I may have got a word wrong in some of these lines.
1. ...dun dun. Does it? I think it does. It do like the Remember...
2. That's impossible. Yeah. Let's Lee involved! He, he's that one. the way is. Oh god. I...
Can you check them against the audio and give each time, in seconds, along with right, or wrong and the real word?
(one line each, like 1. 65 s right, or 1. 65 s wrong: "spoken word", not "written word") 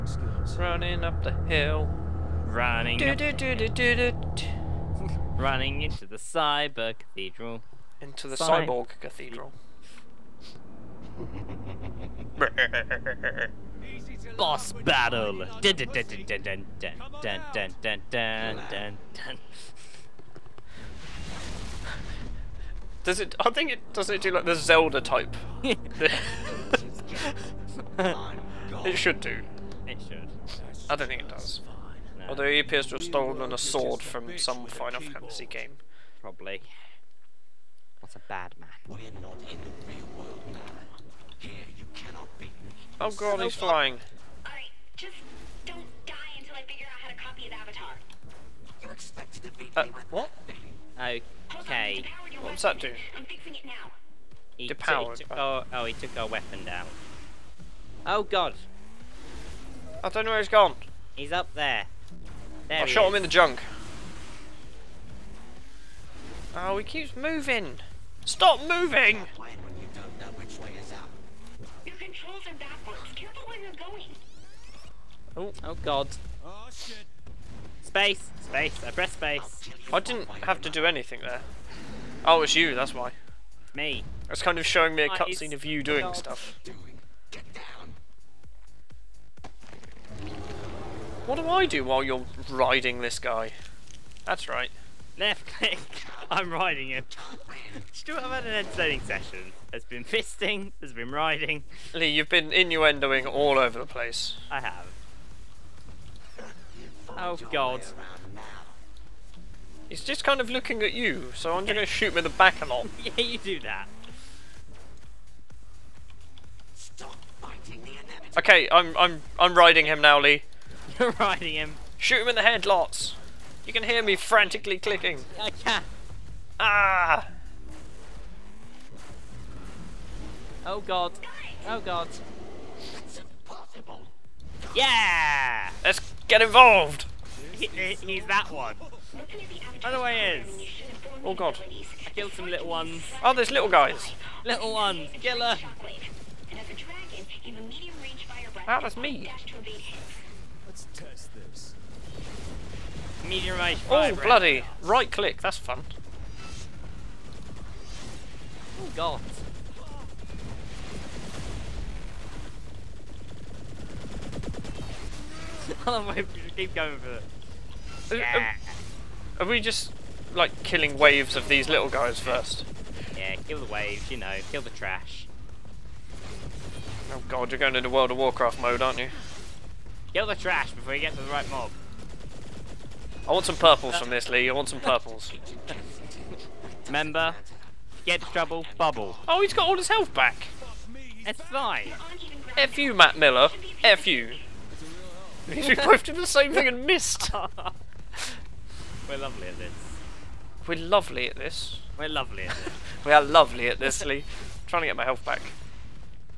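1. 18 s wrong: "Zelda", not "Remember"
2. 132 s wrong: "Get", not "Lee".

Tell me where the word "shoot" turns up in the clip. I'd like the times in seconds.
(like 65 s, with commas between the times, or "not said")
111 s, 121 s.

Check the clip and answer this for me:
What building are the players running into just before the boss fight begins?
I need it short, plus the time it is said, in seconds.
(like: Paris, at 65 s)
cyborg cathedral, at 8 s.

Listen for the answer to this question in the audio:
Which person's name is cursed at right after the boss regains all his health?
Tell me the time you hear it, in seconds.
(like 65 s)
192 s.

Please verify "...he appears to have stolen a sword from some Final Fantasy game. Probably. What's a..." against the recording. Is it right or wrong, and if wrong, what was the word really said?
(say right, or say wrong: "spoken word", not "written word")
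right.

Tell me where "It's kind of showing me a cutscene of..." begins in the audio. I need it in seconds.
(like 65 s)
84 s.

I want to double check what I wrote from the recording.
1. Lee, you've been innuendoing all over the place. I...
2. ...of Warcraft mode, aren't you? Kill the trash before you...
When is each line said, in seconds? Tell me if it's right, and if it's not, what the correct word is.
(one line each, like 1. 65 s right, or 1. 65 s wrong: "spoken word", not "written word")
1. 101 s right
2. 178 s right.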